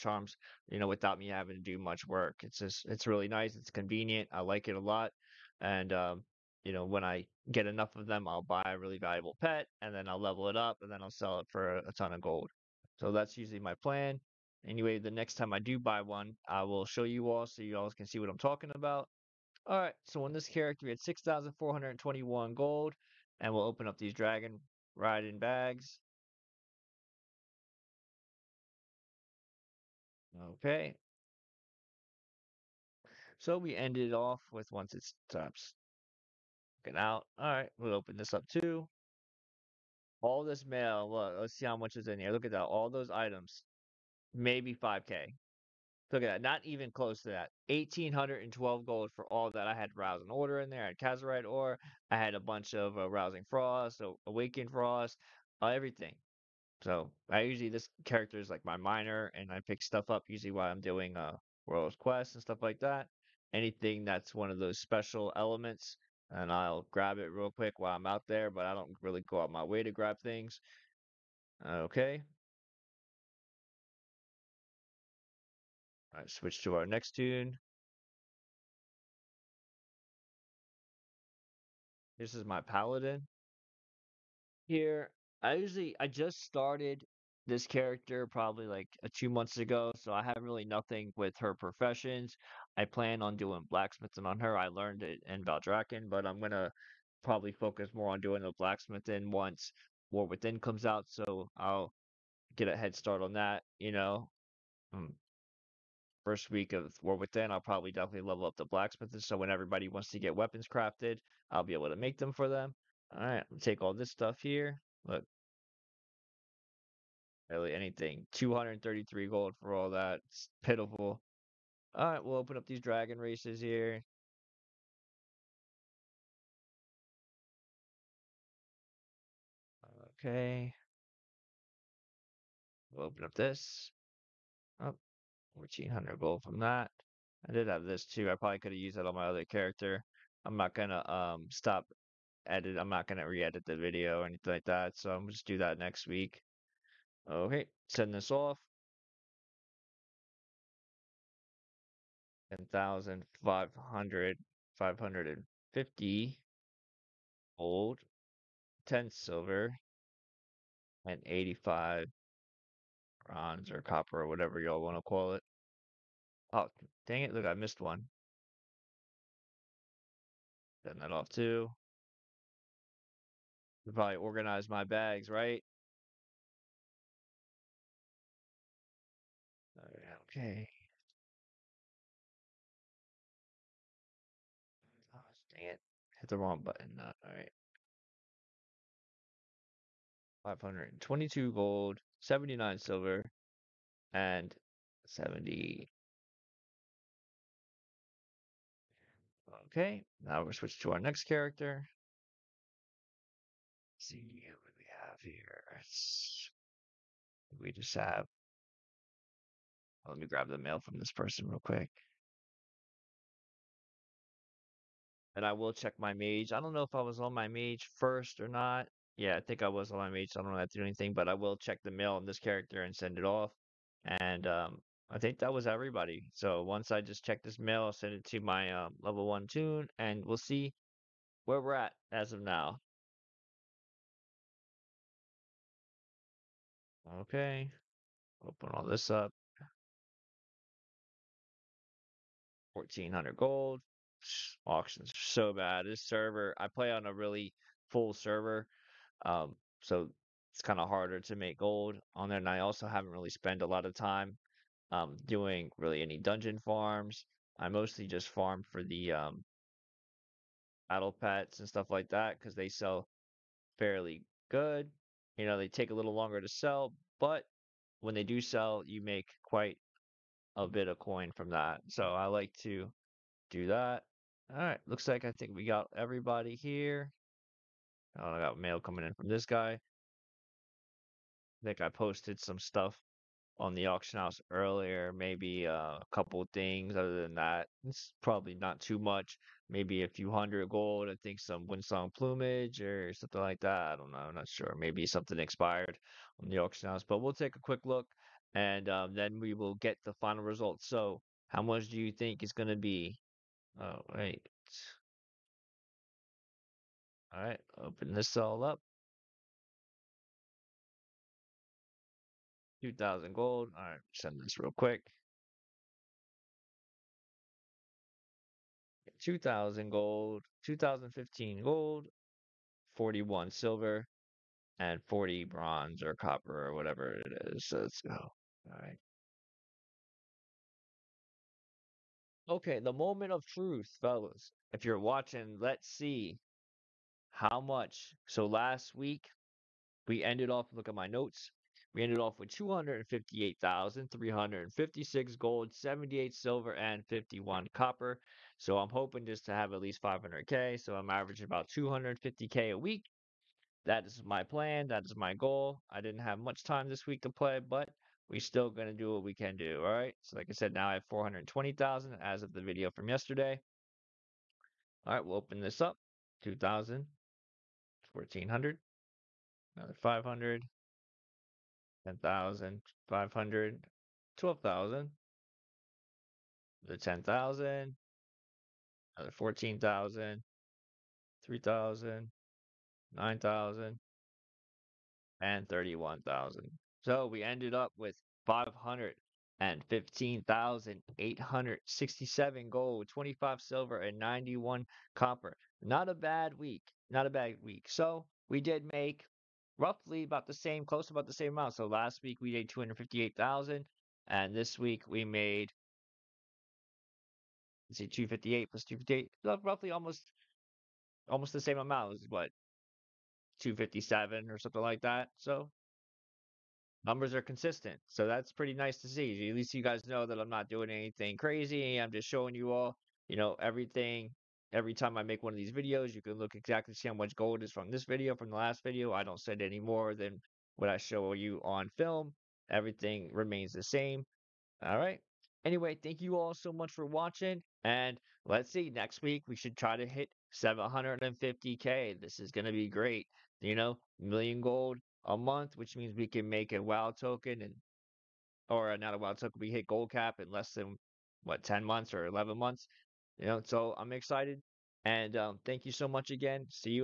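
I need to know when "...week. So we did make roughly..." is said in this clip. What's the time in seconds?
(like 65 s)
397 s.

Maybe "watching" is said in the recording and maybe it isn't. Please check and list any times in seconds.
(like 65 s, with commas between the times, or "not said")
334 s, 437 s.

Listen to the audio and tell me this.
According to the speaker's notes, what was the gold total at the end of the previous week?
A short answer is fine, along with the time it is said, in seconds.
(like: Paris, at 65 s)
258,356 gold, at 342 s.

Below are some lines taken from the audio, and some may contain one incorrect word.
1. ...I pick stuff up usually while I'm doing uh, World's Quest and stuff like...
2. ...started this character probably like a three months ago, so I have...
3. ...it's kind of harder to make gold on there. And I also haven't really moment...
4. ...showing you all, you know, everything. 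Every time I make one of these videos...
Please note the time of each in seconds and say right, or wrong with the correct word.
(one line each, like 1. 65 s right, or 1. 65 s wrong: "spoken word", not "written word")
1. 59 s right
2. 86 s wrong: "two", not "three"
3. 250 s wrong: "spent", not "moment"
4. 422 s right.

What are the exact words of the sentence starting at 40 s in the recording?
All this mail, look, let's see how much is in here.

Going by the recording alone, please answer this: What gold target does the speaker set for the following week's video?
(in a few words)
750K.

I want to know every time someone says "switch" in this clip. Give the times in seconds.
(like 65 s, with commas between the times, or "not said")
76 s, 200 s.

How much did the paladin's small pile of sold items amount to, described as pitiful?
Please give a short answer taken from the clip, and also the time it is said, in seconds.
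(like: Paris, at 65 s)
233 gold, at 118 s.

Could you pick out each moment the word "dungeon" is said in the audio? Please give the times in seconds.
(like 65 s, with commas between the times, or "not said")
256 s.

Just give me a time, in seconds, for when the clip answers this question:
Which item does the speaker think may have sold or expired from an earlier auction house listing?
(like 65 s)
291 s.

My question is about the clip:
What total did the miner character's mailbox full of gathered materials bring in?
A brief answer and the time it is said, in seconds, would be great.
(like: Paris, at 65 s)
1,812 gold, at 47 s.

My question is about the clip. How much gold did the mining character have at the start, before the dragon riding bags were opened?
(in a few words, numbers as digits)
6,421 gold.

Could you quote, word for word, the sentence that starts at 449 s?
We hit gold cap in less than what ten months or eleven months.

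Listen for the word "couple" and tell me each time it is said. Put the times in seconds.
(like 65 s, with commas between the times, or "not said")
286 s.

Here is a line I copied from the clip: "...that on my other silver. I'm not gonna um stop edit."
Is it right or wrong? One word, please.
wrong.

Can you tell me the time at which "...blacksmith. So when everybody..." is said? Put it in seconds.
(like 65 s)
108 s.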